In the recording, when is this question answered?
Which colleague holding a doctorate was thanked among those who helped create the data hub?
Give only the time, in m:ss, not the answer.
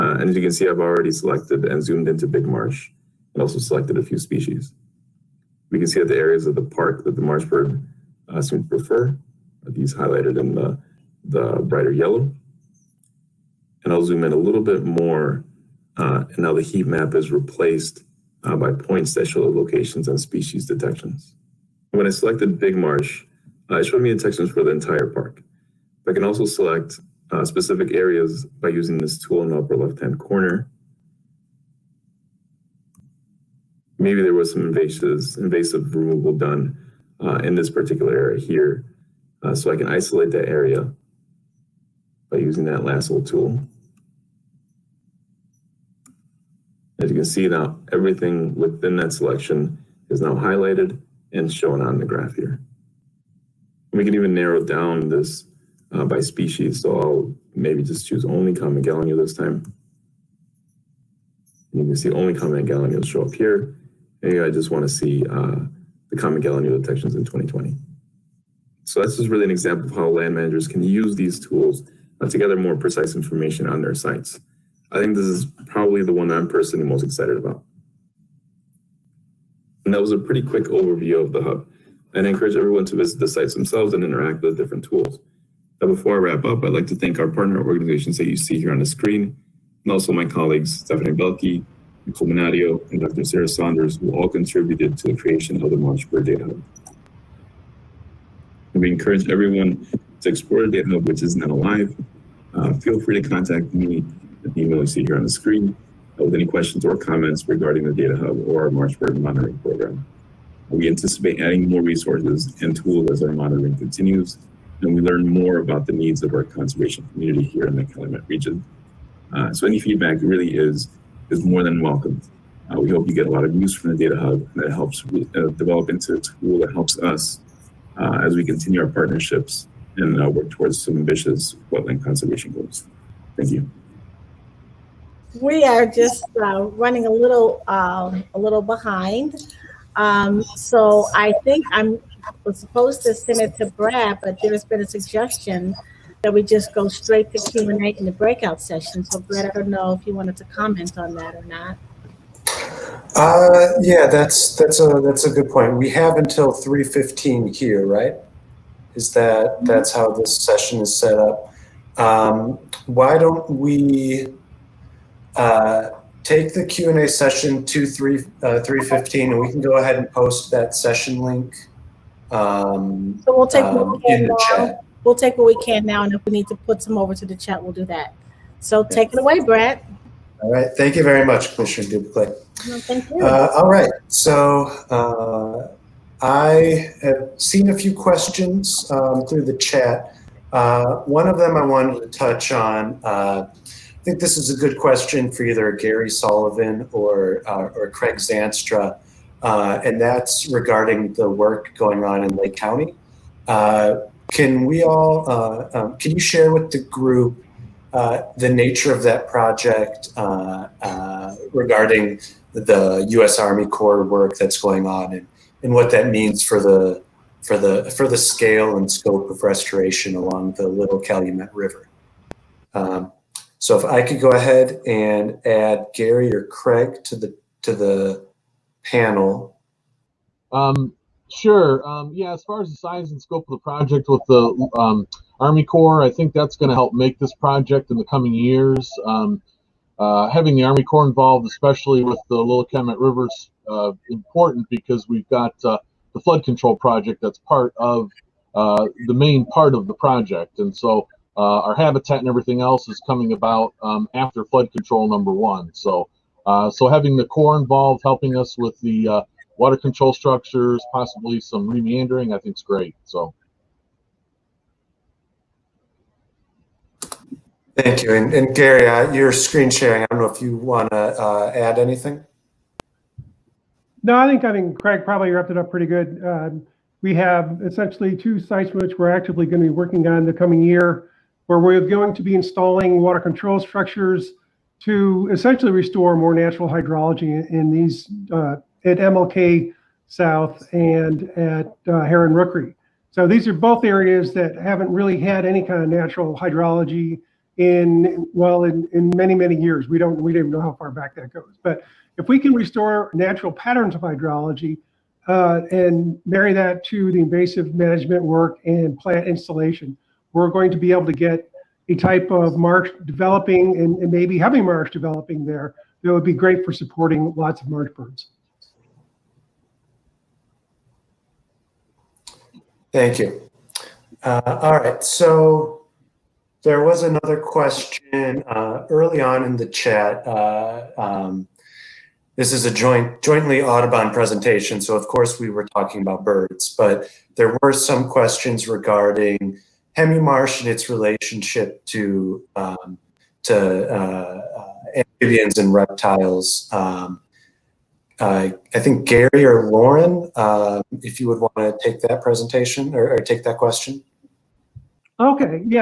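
1:33.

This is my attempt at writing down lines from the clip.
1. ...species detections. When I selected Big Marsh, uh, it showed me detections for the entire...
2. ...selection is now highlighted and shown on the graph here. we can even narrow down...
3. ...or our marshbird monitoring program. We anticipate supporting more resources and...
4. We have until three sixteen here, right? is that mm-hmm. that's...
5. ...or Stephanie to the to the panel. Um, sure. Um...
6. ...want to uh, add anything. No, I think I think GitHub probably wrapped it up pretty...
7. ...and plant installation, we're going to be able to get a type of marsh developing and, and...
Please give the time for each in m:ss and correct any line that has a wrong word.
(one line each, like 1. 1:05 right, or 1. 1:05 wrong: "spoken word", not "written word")
1. 0:20 right
2. 0:49 right
3. 1:48 wrong: "adding", not "supporting"
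4. 2:35 wrong: "fifteen", not "sixteen"
5. 3:46 wrong: "Craig", not "Stephanie"
6. 4:30 wrong: "Craig", not "GitHub"
7. 5:08 right.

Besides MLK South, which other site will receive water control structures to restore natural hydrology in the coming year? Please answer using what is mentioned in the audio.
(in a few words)
Heron Rookery.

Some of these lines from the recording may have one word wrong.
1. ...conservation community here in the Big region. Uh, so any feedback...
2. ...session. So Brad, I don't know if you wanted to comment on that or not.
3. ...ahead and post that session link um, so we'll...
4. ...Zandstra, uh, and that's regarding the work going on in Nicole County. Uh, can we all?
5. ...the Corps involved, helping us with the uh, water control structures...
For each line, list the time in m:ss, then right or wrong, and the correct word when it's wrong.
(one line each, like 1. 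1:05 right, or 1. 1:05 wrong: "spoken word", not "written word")
1. 1:56 wrong: "Calumet", not "Big"
2. 2:28 right
3. 2:49 right
4. 3:18 wrong: "Lake", not "Nicole"
5. 4:17 right.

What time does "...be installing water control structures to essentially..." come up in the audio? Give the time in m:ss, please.
4:42.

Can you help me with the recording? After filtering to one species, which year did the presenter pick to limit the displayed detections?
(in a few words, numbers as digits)
2020.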